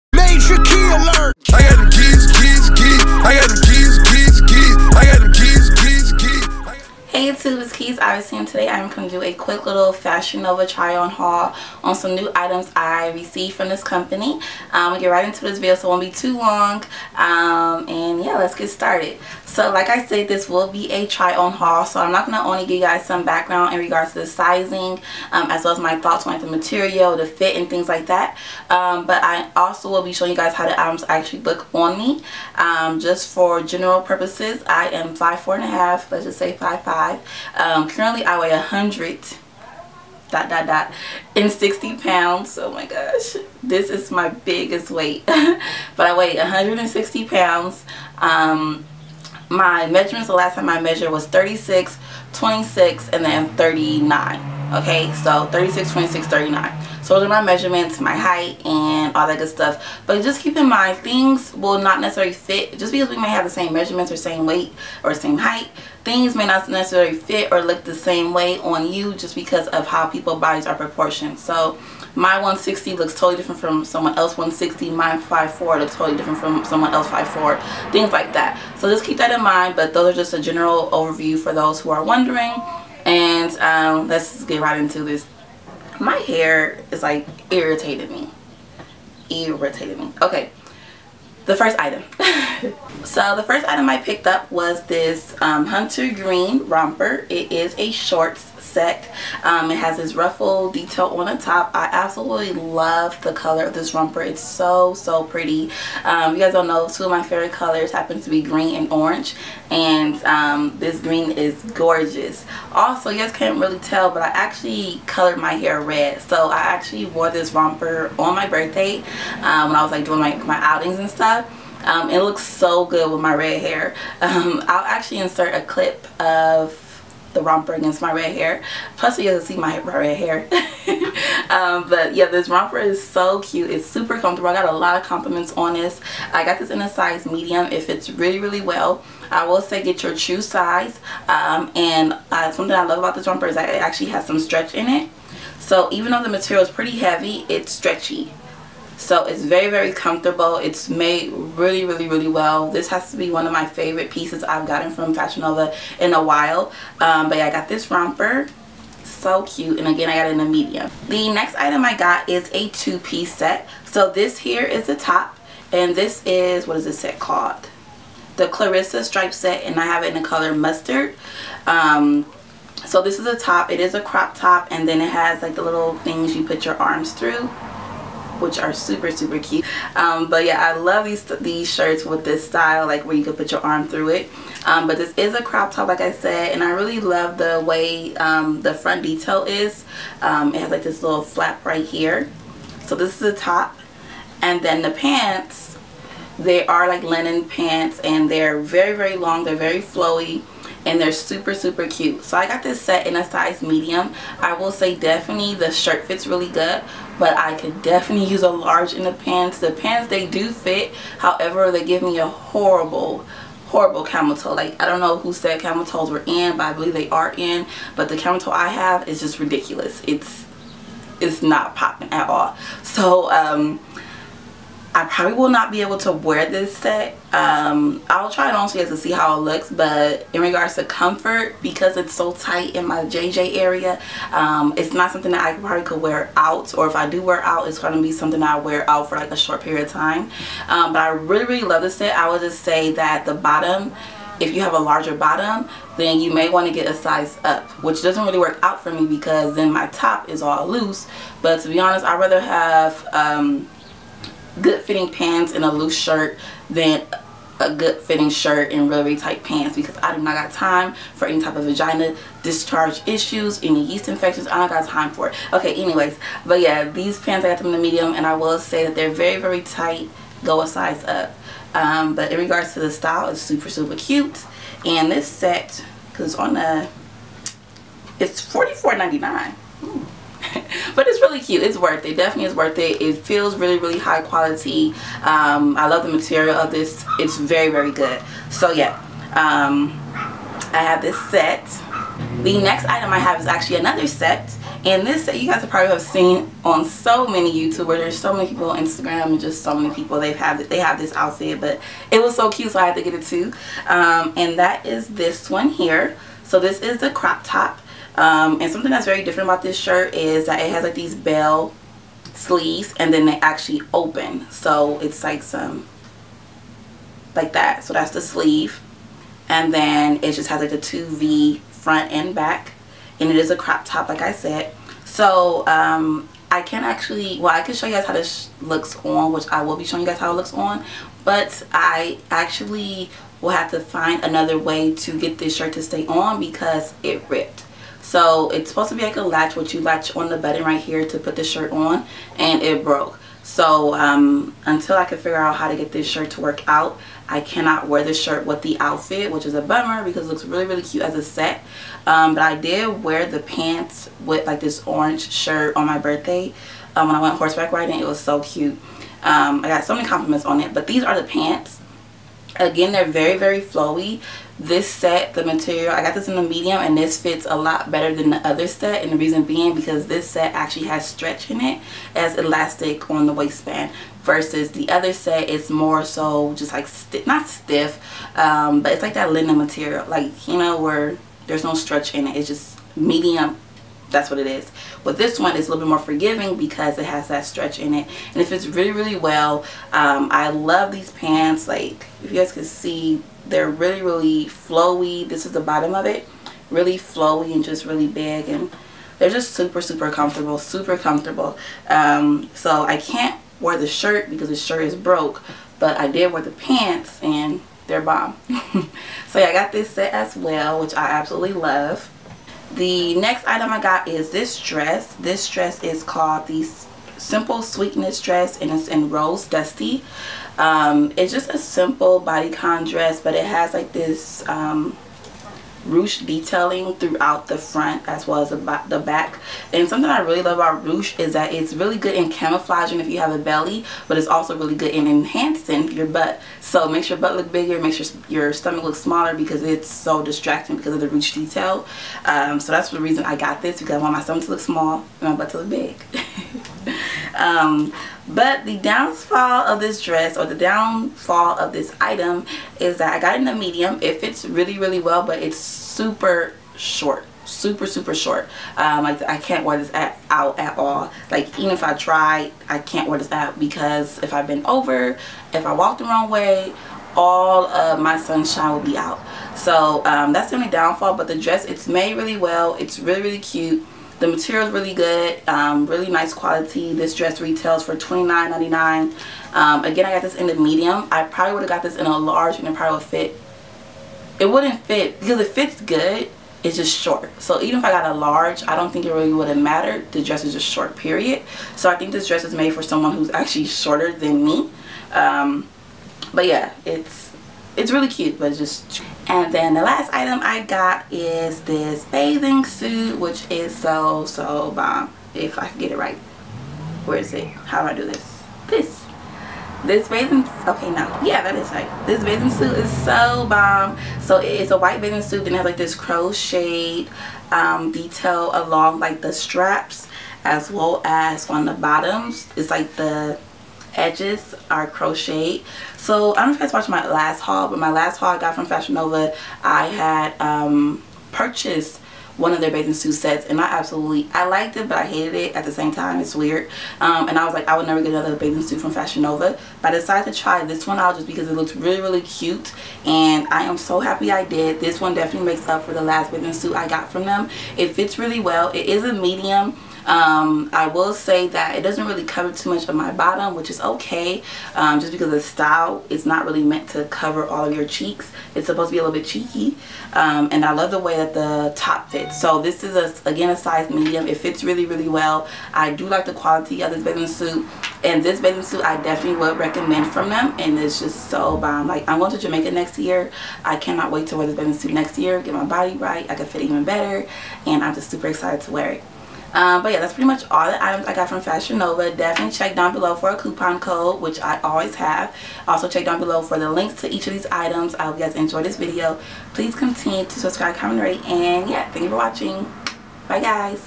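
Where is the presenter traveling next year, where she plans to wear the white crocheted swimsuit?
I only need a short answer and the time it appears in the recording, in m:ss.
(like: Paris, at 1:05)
Jamaica, at 9:32.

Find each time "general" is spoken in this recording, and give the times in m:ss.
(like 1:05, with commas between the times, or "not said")
0:33, 1:20.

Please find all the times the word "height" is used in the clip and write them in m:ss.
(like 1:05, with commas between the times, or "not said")
0:58, 1:05.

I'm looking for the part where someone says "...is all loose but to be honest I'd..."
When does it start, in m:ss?
4:10.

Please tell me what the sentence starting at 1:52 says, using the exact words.
Also, you guys can't really tell, but I actually colored my hair red.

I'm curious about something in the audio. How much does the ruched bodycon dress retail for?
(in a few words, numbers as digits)
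$29.99.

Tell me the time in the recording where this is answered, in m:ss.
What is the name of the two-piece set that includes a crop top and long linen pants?
2:48.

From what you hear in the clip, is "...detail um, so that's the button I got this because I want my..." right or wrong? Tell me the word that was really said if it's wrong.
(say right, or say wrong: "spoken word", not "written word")
wrong: "reason", not "button".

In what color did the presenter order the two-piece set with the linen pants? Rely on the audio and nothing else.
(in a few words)
Mustard.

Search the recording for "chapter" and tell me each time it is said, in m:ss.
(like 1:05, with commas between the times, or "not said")
not said.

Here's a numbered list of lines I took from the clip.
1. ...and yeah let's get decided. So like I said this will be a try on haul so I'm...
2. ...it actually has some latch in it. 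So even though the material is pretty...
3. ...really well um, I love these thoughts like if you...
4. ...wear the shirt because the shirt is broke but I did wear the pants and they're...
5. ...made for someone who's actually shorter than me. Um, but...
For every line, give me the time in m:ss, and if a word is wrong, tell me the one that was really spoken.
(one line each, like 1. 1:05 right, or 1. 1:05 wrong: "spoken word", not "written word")
1. 0:17 wrong: "started", not "decided"
2. 2:23 wrong: "stretch", not "latch"
3. 6:28 wrong: "pants", not "thoughts"
4. 6:43 right
5. 8:12 right.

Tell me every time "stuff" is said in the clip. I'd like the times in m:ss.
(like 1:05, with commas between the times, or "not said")
0:59, 2:01.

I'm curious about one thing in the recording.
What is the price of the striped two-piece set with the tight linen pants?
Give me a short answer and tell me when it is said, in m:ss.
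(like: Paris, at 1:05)
$44.99, at 4:38.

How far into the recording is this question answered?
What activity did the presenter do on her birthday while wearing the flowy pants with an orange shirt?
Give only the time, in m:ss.
5:57.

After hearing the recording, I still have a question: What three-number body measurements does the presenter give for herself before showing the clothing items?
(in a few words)
36 26 39.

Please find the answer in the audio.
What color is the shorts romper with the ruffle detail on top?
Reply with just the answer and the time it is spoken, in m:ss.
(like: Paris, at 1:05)
Hunter Green, at 1:35.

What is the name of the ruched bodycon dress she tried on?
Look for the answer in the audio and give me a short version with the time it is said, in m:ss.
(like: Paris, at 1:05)
Simple Sweetness Dress, at 6:57.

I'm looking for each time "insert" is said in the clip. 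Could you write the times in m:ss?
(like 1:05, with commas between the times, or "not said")
2:05.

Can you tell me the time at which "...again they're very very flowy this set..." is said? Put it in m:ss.
6:02.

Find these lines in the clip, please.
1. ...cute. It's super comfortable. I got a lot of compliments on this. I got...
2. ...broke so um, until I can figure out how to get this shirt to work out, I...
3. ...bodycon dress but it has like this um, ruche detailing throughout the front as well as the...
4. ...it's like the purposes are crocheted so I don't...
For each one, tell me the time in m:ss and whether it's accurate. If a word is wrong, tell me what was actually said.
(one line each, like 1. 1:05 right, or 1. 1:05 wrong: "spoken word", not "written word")
1. 2:13 right
2. 5:42 right
3. 7:02 right
4. 8:42 wrong: "edges", not "purposes".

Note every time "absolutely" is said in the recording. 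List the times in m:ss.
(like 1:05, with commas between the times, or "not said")
1:41, 6:51, 8:53.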